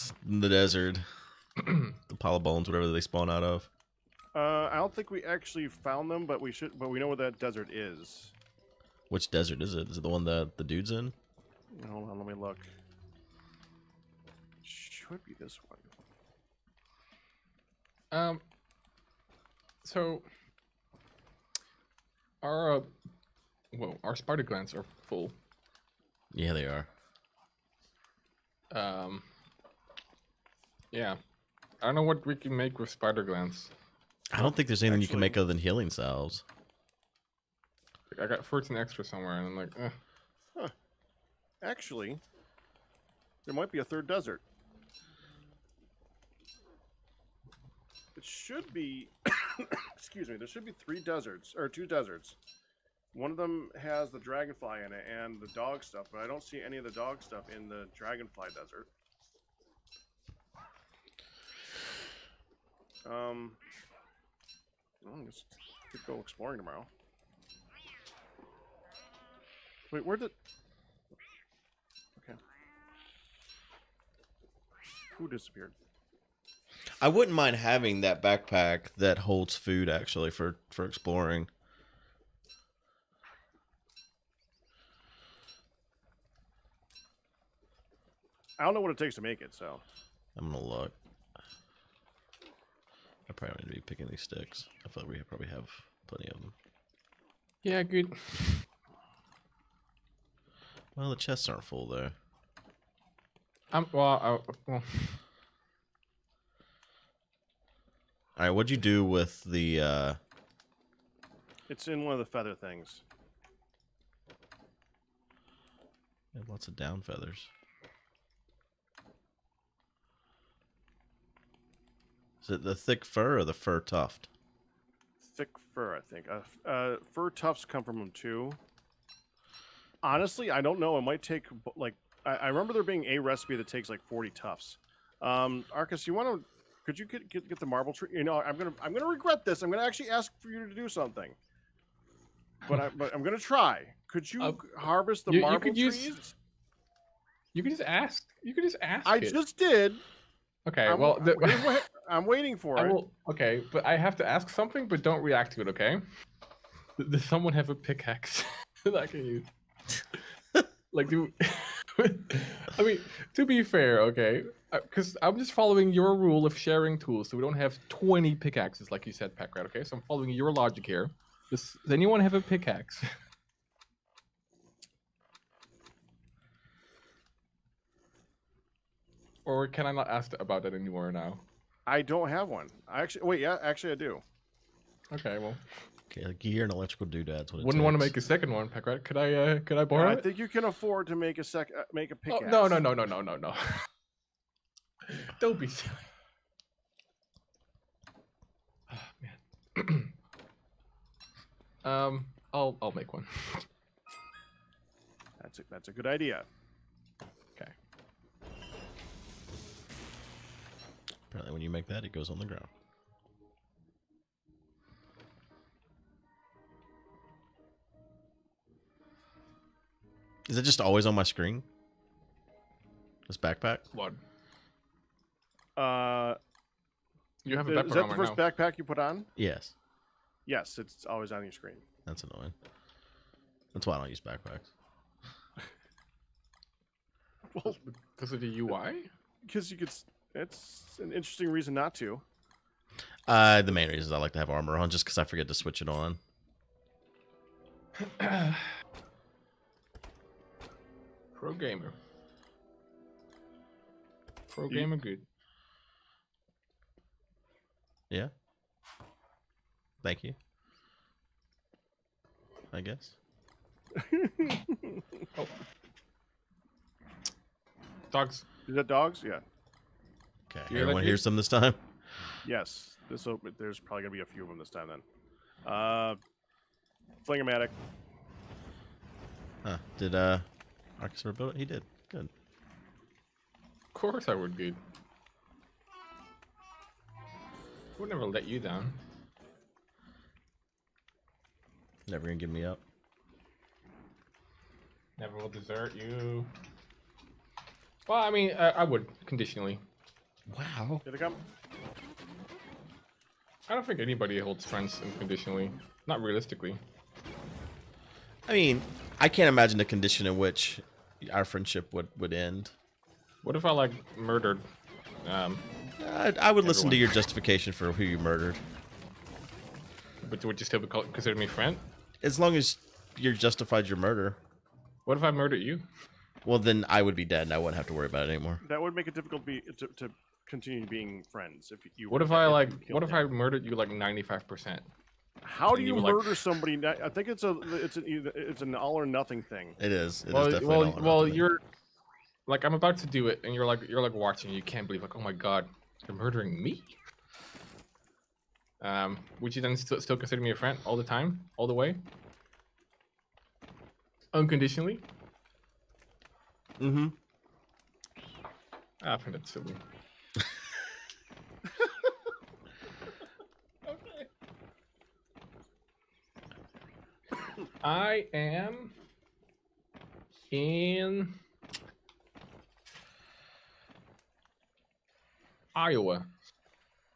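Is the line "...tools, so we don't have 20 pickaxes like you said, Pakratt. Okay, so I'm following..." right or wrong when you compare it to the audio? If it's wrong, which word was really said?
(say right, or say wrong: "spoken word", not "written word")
right.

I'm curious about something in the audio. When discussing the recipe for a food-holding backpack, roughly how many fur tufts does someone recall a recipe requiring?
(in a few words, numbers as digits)
40.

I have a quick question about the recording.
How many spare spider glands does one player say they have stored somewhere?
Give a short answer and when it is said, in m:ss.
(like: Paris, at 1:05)
14, at 0:38.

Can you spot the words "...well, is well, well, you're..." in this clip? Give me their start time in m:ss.
5:40.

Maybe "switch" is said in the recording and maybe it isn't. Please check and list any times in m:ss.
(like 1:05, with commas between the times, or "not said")
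4:05.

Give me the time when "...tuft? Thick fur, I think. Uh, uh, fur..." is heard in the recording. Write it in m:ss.
2:03.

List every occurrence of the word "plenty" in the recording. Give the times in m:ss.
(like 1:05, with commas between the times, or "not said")
1:36.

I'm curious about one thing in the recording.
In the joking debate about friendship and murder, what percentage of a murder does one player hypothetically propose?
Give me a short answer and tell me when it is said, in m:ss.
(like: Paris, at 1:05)
95, at 5:33.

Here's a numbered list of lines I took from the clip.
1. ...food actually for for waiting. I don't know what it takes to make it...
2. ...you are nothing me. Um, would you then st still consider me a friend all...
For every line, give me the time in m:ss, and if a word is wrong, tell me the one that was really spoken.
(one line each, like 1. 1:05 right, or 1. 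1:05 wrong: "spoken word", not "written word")
1. 1:19 wrong: "exploring", not "waiting"
2. 5:46 wrong: "murdering", not "nothing".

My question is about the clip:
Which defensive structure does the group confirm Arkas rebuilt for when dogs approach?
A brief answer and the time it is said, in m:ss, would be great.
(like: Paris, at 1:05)
Flingomatic, at 4:37.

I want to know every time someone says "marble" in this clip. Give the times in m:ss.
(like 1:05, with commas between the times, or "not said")
2:17, 2:25.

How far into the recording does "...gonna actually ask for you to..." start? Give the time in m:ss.
2:19.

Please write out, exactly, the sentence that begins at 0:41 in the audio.
Actually, there might be a third desert.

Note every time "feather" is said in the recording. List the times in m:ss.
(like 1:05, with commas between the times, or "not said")
1:52, 1:57.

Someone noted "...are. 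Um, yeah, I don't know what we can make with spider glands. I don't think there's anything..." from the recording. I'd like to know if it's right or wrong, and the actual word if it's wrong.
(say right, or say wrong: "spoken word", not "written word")
right.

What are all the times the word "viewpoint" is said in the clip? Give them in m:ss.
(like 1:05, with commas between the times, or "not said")
not said.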